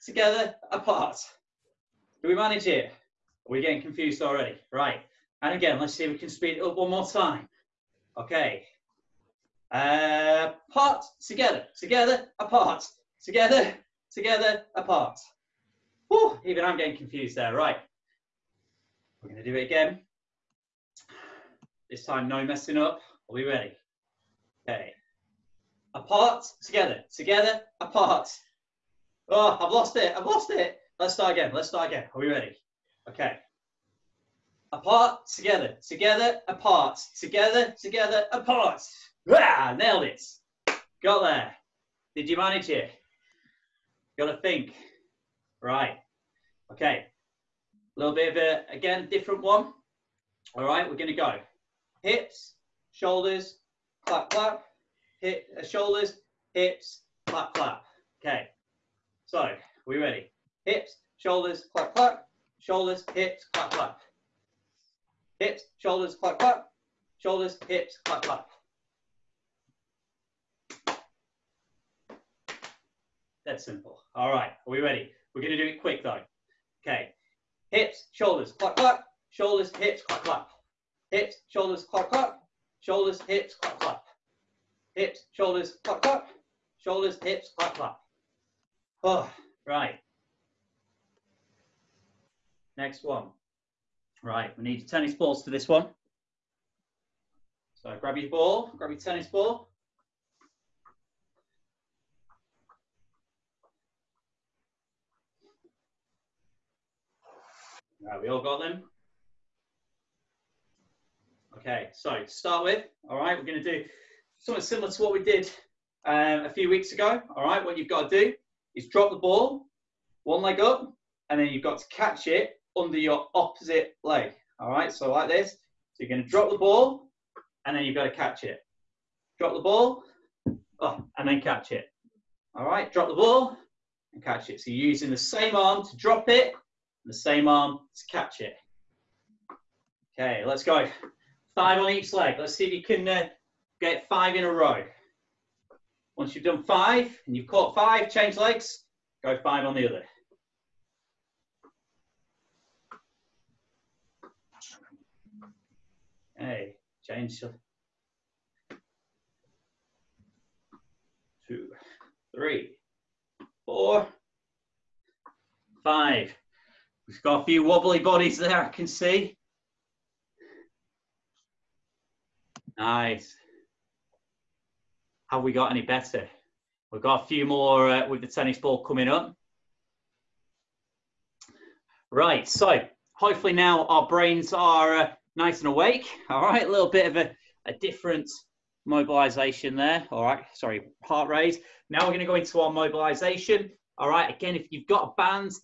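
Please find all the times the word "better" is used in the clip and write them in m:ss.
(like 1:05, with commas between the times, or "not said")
2:55.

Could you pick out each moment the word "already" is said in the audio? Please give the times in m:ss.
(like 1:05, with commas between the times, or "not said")
0:04.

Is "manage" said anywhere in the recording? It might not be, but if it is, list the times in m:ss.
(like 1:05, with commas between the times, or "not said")
0:02, 0:42.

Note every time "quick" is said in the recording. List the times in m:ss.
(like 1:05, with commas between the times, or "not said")
1:15.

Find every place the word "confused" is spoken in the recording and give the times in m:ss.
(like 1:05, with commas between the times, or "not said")
0:03, 0:16.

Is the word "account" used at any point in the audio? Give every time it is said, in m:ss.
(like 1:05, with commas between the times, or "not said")
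not said.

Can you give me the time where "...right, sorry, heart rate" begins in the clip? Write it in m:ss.
3:10.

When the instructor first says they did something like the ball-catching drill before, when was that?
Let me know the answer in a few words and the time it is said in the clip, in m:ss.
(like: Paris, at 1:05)
a few weeks ago, at 1:56.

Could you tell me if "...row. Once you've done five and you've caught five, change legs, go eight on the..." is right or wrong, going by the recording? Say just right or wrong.
wrong.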